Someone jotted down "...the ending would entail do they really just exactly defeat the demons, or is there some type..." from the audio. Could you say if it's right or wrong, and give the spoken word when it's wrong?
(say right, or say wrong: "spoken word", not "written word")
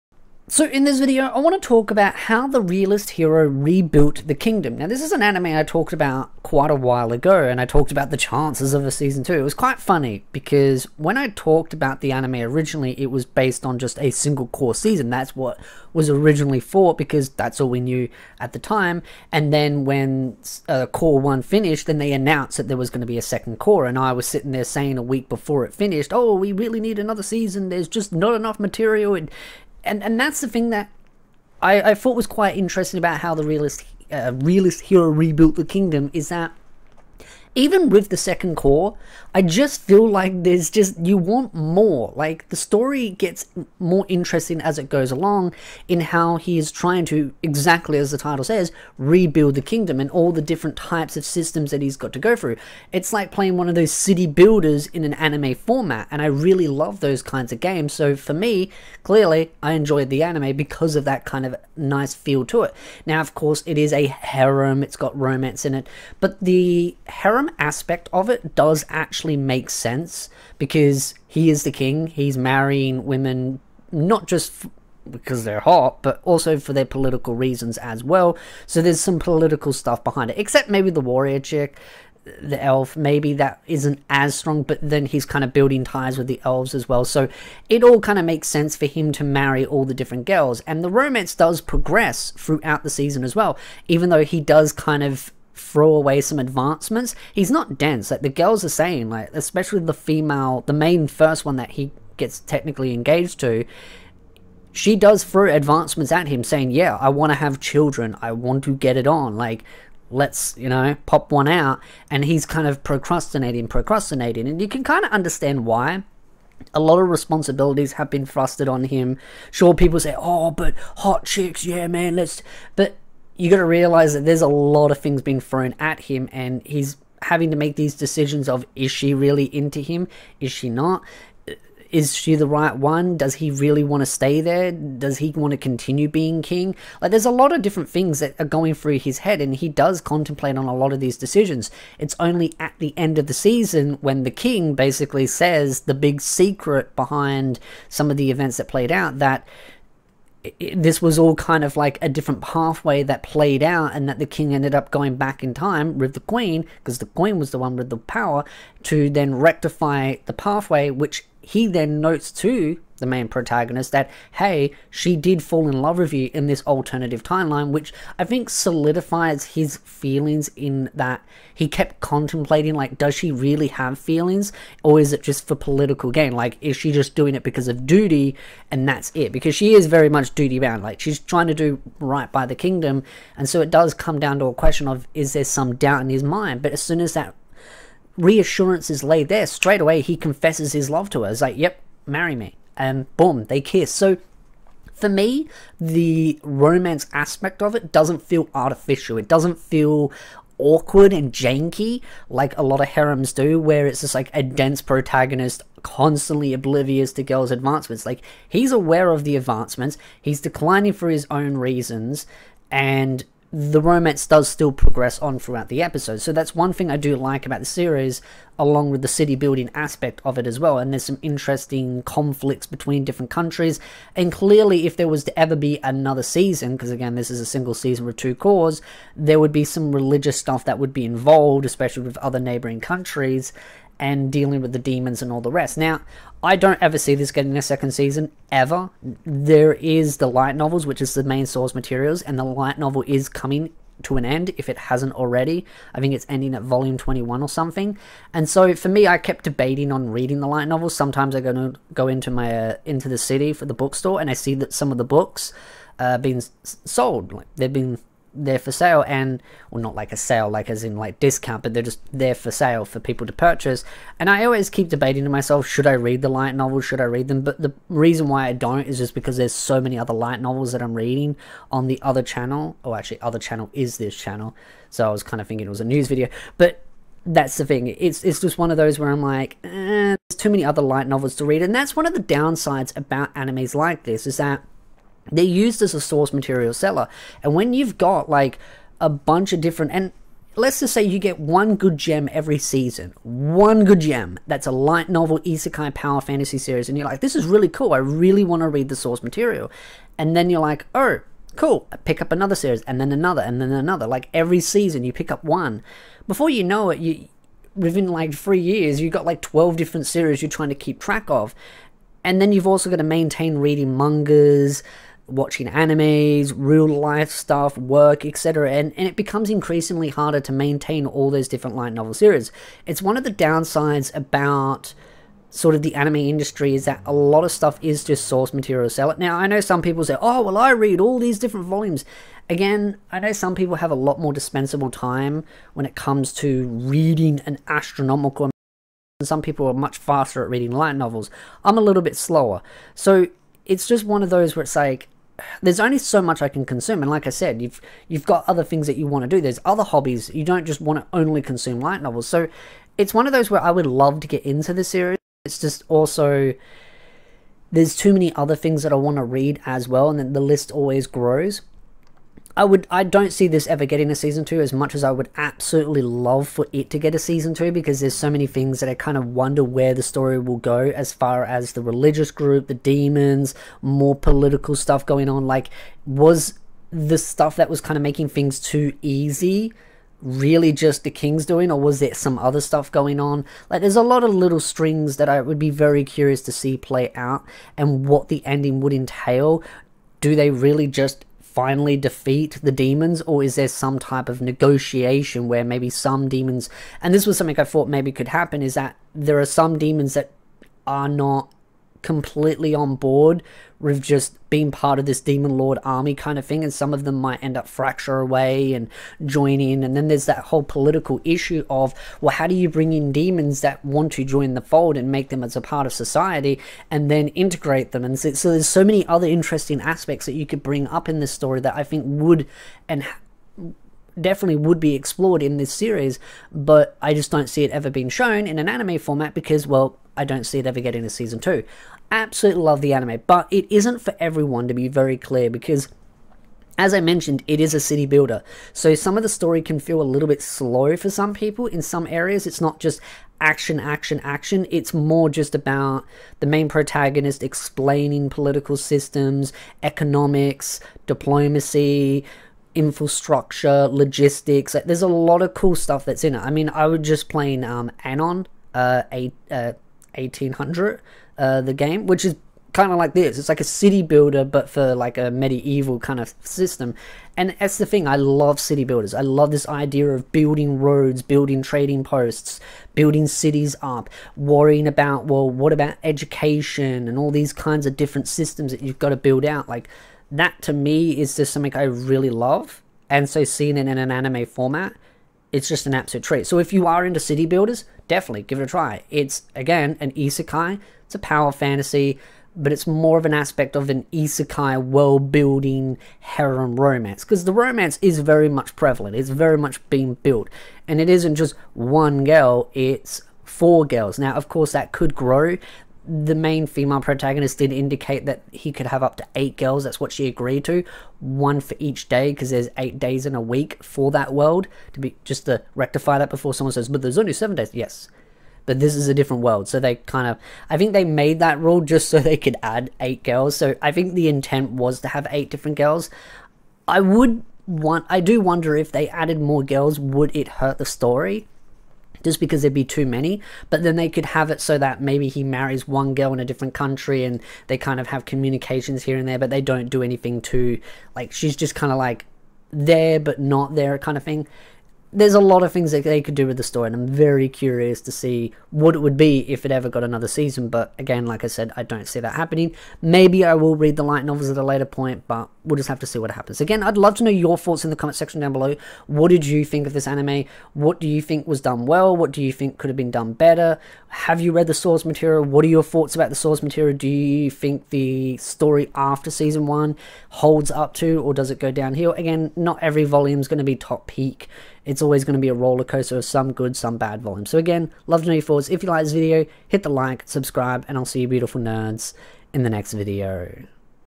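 wrong: "finally", not "exactly".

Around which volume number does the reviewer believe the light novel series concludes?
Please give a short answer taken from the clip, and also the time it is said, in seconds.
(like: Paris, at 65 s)
21, at 246 s.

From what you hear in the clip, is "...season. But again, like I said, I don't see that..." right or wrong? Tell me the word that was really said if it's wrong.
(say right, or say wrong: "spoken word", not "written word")
right.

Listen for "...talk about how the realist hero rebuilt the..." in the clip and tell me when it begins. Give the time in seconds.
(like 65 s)
1 s.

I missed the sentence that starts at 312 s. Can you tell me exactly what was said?
And then you've also got to maintain reading mangas watching animes, real life stuff, work, etc.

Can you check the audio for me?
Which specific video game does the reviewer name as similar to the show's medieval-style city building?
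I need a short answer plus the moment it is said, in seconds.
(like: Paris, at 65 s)
Anno 1800, at 458 s.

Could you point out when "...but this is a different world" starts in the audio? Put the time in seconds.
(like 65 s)
518 s.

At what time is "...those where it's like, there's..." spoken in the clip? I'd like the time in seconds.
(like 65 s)
344 s.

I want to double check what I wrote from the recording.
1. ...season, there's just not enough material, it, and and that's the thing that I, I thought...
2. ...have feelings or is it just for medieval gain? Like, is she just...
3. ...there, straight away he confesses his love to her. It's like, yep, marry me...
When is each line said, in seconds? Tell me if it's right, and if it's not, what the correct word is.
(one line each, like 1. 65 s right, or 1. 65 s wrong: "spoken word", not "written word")
1. 27 s right
2. 173 s wrong: "political", not "medieval"
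3. 189 s right.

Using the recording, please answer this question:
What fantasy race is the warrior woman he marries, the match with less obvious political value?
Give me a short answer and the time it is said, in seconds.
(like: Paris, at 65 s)
Elf, at 82 s.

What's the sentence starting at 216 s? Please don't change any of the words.
So that's one thing I do like about the series, along with the city building aspect of it as well.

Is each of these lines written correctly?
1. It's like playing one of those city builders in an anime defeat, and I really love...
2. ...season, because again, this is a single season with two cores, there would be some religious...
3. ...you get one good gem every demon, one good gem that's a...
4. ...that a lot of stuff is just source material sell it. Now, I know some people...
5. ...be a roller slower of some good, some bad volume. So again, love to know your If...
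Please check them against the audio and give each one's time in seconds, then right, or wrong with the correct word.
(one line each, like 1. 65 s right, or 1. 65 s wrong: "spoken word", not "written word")
1. 52 s wrong: "format", not "defeat"
2. 226 s right
3. 291 s wrong: "season", not "demon"
4. 326 s right
5. 575 s wrong: "coaster", not "slower".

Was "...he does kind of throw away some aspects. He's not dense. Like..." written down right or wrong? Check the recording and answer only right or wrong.
wrong.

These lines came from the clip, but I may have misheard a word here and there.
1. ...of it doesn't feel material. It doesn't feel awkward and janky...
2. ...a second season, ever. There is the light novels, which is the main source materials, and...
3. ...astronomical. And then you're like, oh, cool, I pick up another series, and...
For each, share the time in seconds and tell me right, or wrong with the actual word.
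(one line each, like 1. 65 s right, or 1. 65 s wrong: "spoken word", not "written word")
1. 197 s wrong: "artificial", not "material"
2. 237 s right
3. 299 s wrong: "material", not "astronomical".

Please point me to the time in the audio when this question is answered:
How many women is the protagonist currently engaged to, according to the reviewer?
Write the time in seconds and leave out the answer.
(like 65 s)
503 s.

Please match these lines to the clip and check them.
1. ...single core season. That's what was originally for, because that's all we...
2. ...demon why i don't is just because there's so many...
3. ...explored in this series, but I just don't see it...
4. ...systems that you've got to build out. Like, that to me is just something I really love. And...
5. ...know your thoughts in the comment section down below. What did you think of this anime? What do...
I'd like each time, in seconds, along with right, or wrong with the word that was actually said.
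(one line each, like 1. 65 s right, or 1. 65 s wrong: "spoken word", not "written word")
1. 14 s right
2. 267 s wrong: "reason", not "demon"
3. 424 s right
4. 478 s right
5. 557 s right.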